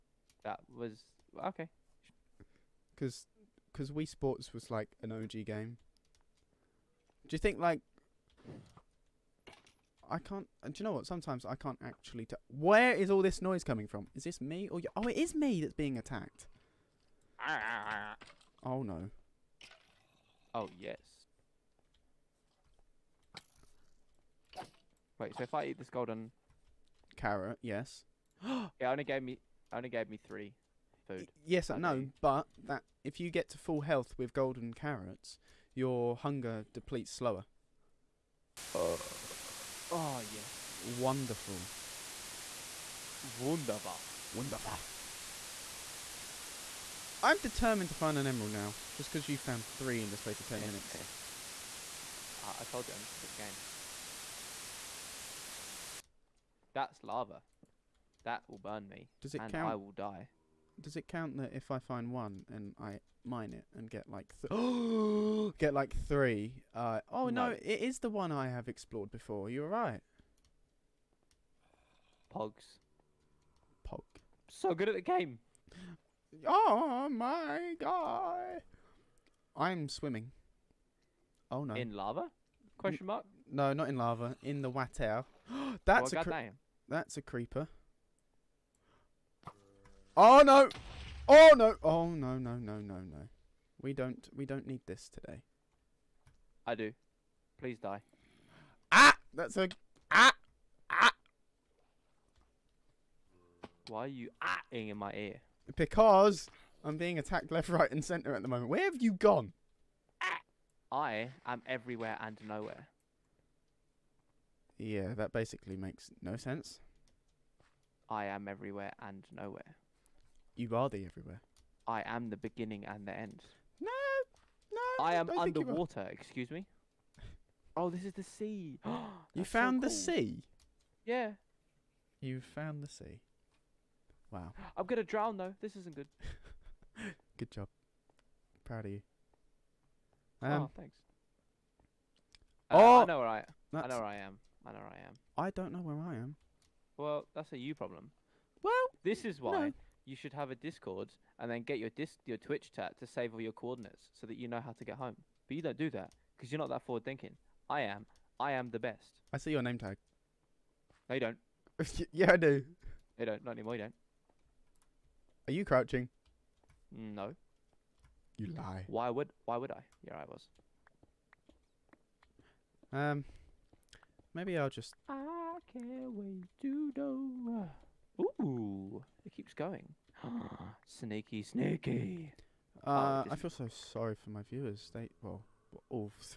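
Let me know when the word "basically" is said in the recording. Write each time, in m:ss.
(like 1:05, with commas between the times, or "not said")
1:55.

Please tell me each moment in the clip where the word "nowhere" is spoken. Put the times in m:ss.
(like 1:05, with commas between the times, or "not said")
1:52, 1:59.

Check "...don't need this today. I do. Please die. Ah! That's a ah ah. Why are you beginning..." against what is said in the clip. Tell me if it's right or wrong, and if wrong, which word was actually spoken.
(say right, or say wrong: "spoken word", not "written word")
wrong: "ahing", not "beginning".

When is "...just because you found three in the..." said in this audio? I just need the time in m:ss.
0:48.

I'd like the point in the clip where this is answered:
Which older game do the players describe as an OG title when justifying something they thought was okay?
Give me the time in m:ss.
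0:03.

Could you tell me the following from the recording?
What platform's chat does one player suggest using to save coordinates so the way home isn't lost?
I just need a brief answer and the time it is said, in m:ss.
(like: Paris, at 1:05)
Twitch, at 2:32.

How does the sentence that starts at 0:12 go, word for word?
Where is all this noise coming from?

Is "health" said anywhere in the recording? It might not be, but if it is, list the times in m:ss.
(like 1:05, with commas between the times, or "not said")
0:33.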